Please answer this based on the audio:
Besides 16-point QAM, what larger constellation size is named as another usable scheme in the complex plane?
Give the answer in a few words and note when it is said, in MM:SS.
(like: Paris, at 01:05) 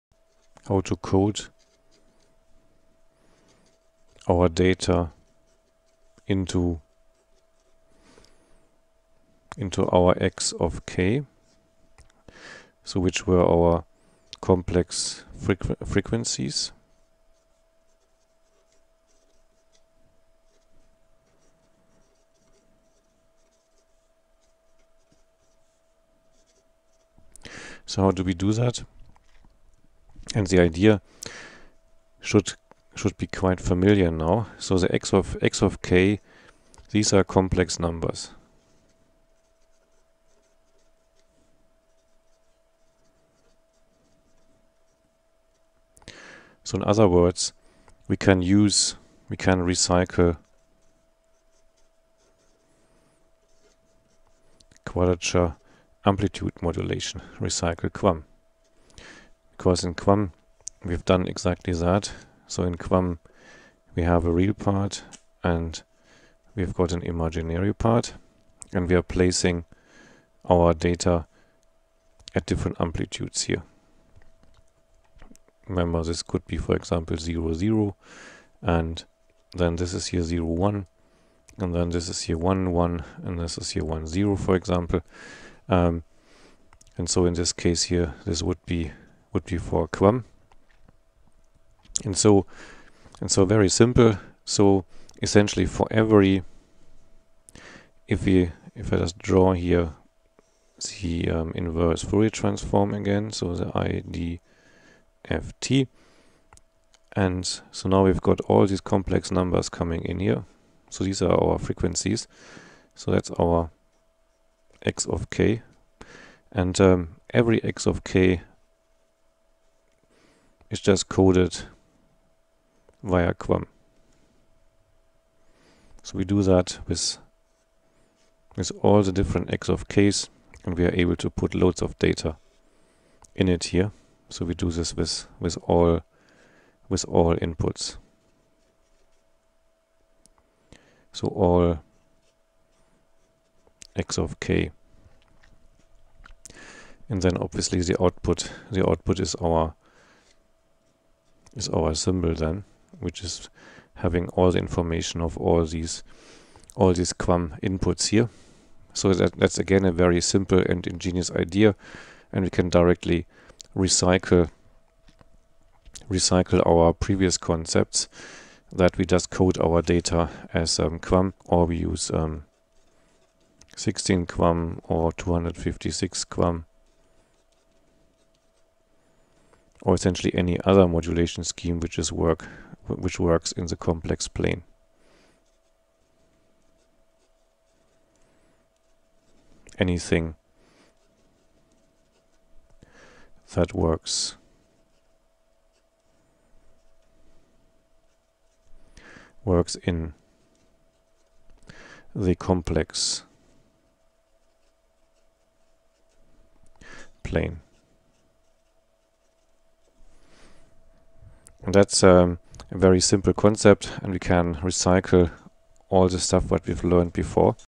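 256 QAM, at 02:55.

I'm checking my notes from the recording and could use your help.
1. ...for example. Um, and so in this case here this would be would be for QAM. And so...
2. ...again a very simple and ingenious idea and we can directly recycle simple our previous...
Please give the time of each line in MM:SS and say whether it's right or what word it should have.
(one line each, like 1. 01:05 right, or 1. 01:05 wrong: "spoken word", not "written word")
1. 01:24 right
2. 02:39 wrong: "recycle", not "simple".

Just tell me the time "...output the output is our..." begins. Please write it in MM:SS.
02:28.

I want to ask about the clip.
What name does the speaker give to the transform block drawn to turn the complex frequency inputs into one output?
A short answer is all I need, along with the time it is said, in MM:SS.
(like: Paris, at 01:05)
IDFT, at 01:45.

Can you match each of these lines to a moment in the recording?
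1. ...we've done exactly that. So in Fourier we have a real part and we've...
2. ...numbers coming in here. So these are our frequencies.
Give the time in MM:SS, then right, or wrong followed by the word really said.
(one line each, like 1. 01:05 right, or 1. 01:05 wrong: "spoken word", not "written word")
1. 01:00 wrong: "QAM", not "Fourier"
2. 01:49 right.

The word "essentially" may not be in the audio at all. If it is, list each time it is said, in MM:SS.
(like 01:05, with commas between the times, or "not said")
01:35, 02:59.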